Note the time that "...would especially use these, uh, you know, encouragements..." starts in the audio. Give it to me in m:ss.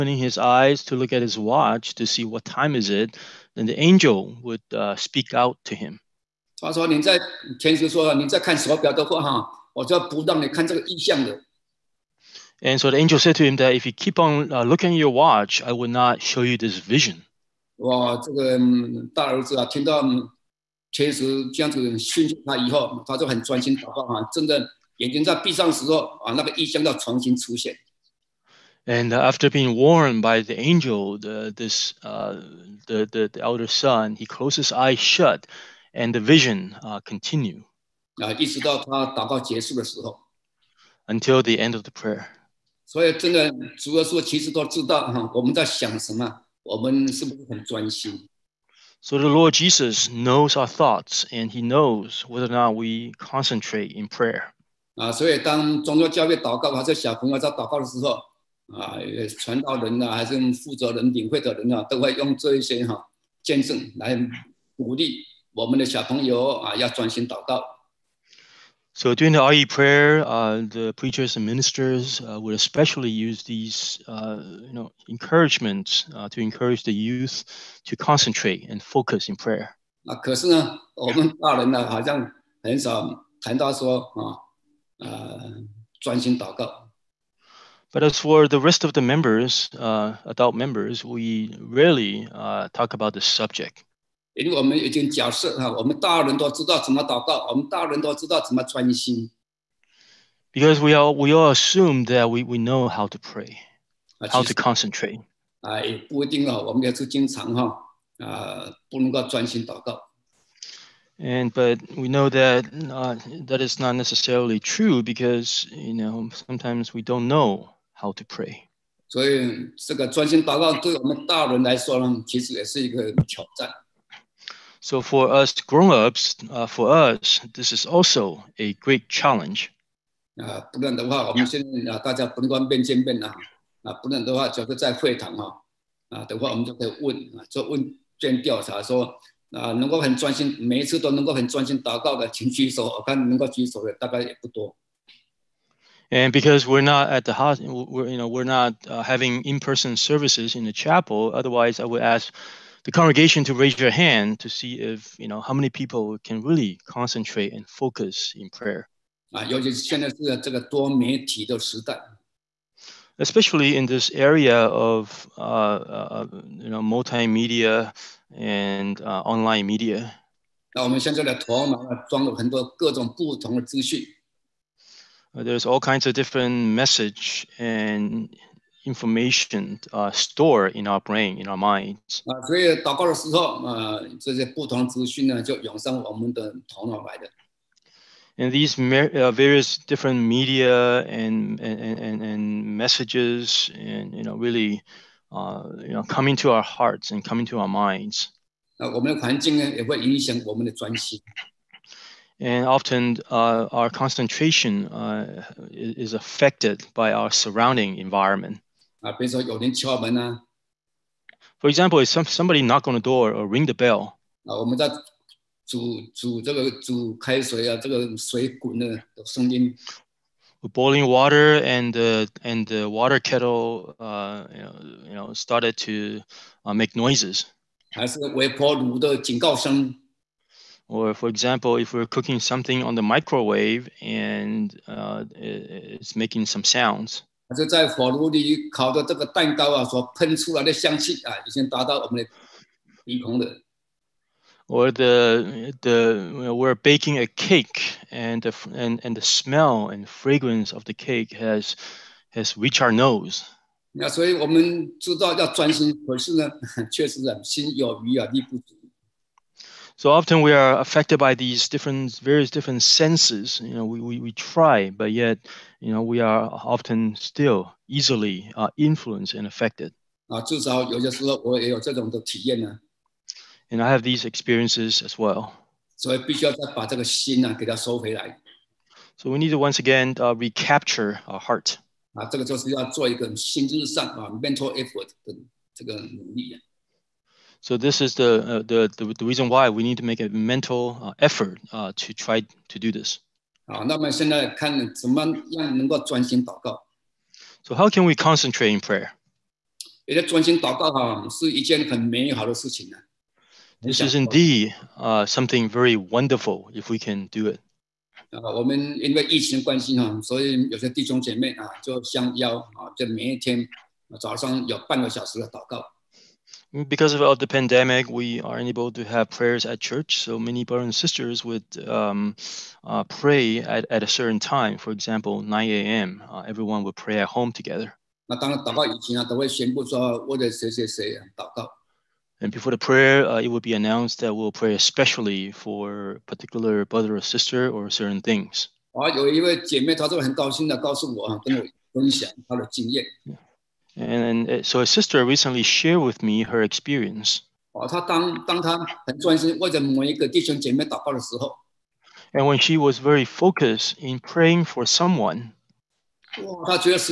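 1:12.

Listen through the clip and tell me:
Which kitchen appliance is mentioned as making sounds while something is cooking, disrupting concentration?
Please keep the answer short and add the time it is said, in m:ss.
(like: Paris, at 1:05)
Microwave, at 3:53.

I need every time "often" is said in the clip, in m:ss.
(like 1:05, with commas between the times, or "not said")
3:22, 4:20, 4:26.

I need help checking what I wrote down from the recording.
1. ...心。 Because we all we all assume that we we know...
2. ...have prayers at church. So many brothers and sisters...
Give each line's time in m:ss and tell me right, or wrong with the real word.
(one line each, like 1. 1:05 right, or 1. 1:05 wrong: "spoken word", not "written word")
1. 1:38 right
2. 5:19 right.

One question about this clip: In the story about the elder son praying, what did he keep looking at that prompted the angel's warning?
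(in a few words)
His watch.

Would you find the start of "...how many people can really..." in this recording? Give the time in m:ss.
2:35.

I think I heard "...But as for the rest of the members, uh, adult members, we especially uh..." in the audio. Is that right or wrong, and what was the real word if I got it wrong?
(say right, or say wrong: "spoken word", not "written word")
wrong: "rarely", not "especially".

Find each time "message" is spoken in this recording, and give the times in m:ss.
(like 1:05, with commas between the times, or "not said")
2:56, 3:12.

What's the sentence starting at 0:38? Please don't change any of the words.
啊， 一 直 到 他 祷 告 结 束 的 时 候。 Until the end of the prayer.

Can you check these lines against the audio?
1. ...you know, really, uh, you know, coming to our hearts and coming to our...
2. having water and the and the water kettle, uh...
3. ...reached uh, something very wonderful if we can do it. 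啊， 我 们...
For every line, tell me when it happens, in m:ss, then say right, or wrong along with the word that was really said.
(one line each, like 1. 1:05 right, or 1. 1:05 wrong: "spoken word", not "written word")
1. 3:14 right
2. 3:40 wrong: "boiling", not "having"
3. 5:04 wrong: "indeed", not "reached".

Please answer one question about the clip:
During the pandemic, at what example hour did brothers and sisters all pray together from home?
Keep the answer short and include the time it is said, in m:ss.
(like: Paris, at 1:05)
9 a.m., at 5:25.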